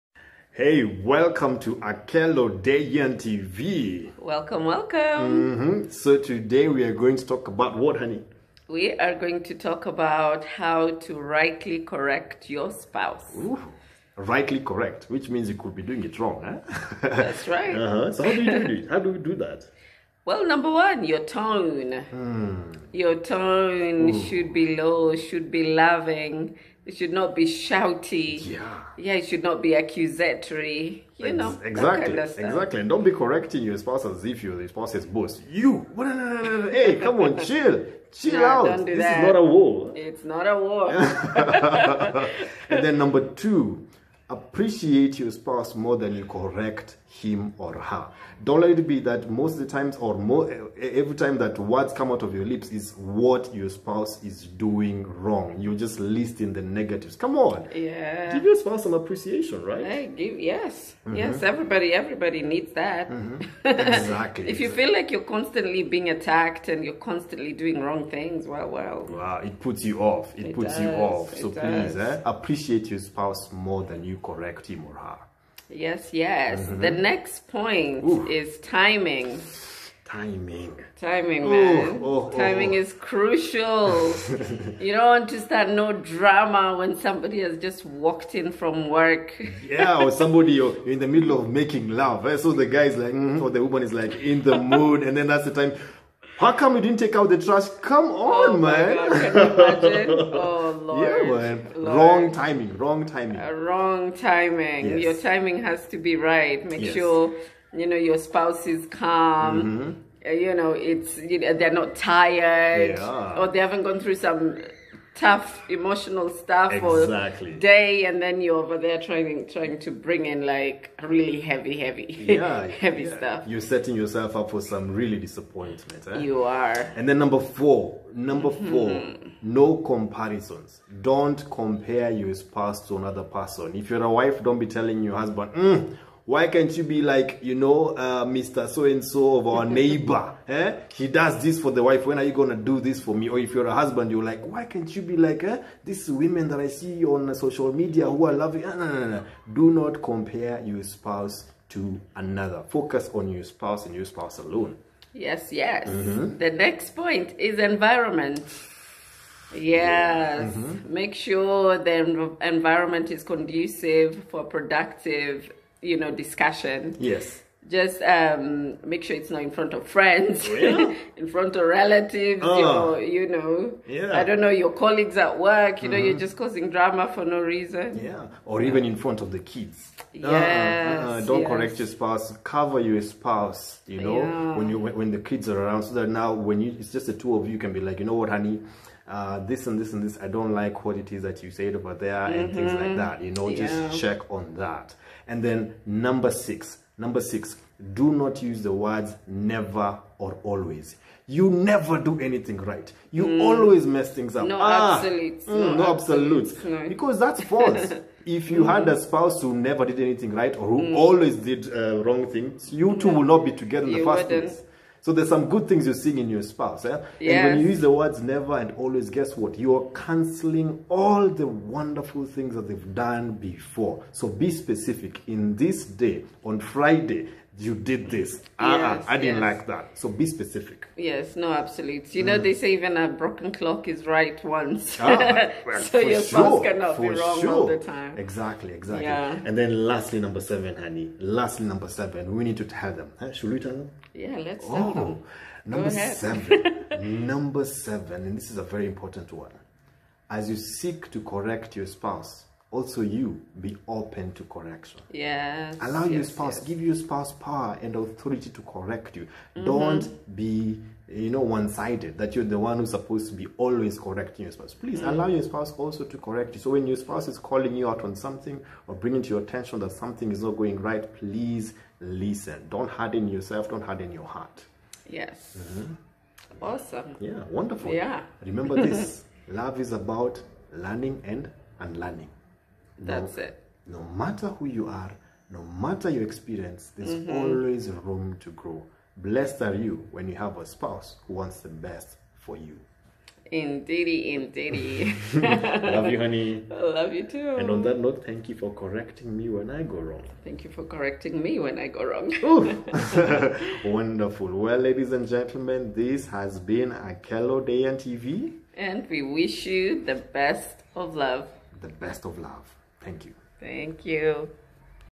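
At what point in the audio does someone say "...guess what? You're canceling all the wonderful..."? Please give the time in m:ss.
3:39.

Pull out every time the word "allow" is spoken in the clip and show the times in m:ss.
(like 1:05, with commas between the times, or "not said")
4:15, 4:25.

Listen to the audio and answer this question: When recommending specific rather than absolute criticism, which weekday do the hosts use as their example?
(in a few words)
Friday.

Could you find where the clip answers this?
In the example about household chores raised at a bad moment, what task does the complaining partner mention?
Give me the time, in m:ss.
1:36.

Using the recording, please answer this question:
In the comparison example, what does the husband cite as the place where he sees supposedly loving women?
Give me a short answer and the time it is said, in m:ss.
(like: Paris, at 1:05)
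Social media, at 2:27.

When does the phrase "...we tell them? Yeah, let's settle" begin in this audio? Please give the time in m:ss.
4:03.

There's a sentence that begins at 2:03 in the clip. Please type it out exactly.
stuff you're setting yourself up for some really disappointment eh?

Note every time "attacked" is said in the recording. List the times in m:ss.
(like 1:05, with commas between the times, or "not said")
1:06.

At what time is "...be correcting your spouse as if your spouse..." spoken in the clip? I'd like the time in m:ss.
0:33.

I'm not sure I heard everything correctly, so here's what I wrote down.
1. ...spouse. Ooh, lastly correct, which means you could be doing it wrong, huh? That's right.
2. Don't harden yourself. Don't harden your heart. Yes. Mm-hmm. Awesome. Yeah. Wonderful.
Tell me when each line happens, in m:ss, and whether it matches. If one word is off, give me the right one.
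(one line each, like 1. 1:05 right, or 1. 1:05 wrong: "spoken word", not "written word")
1. 0:12 wrong: "rightly", not "lastly"
2. 4:32 right.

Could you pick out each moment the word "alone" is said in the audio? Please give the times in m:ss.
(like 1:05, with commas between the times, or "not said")
2:34.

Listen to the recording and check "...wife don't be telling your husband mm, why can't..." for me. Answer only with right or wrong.
right.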